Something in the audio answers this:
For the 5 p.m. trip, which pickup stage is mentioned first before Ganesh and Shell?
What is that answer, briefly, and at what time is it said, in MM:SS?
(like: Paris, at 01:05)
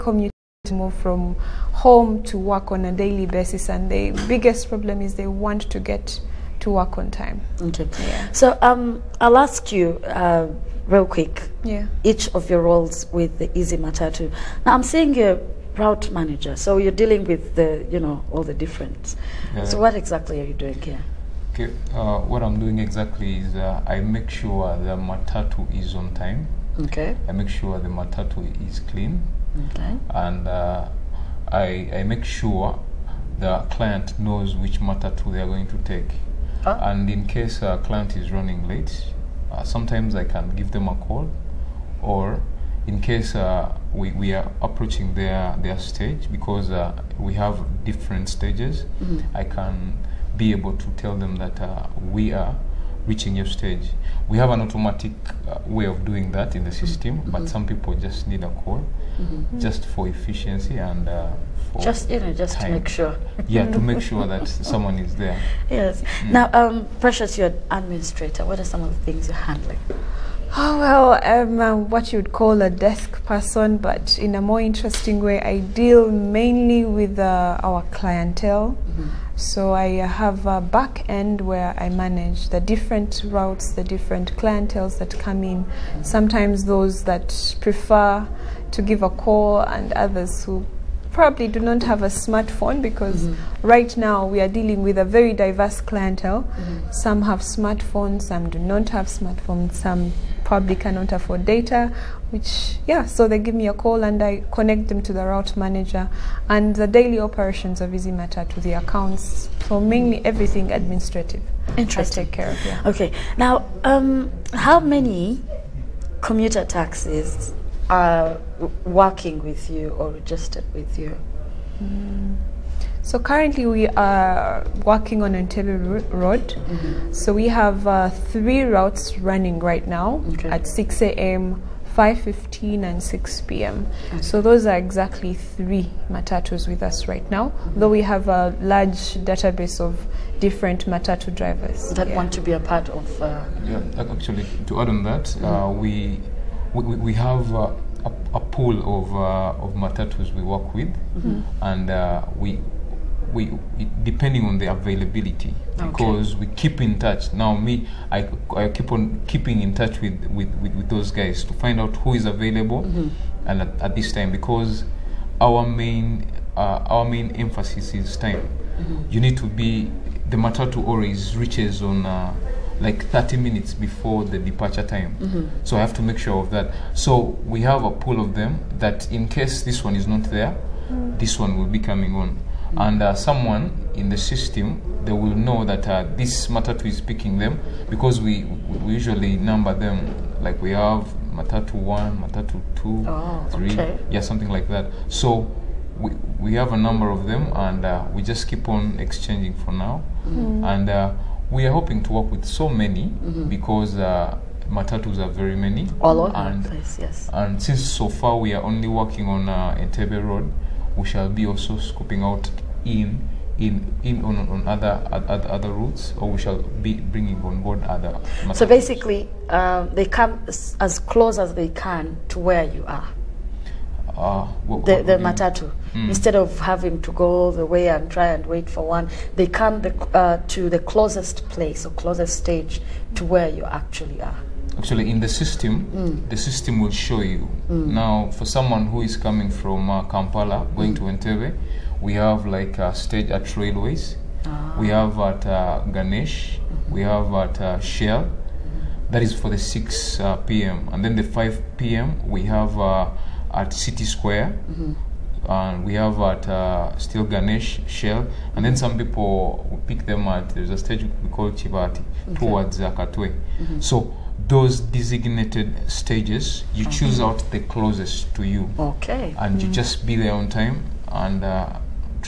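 City Square, at 04:13.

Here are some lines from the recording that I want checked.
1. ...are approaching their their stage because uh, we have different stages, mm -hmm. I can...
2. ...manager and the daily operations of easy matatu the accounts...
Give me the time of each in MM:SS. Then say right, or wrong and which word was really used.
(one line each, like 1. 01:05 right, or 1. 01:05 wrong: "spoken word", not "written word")
1. 00:44 right
2. 01:45 right.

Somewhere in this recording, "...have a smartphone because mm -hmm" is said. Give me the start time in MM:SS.
01:31.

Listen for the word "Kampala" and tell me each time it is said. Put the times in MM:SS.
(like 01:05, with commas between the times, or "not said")
04:00.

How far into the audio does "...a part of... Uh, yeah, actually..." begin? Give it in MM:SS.
02:22.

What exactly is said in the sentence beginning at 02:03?
So currently we are working on Entebbe Road.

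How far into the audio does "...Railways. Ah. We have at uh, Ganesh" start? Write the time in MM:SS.
04:03.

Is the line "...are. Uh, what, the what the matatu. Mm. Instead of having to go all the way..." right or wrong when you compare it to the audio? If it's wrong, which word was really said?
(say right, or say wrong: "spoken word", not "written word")
right.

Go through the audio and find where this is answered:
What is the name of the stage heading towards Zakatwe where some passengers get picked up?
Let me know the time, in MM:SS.
04:21.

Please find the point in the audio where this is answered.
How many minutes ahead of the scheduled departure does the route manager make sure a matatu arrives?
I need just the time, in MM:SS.
02:53.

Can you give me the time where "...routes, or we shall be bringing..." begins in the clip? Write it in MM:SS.
03:35.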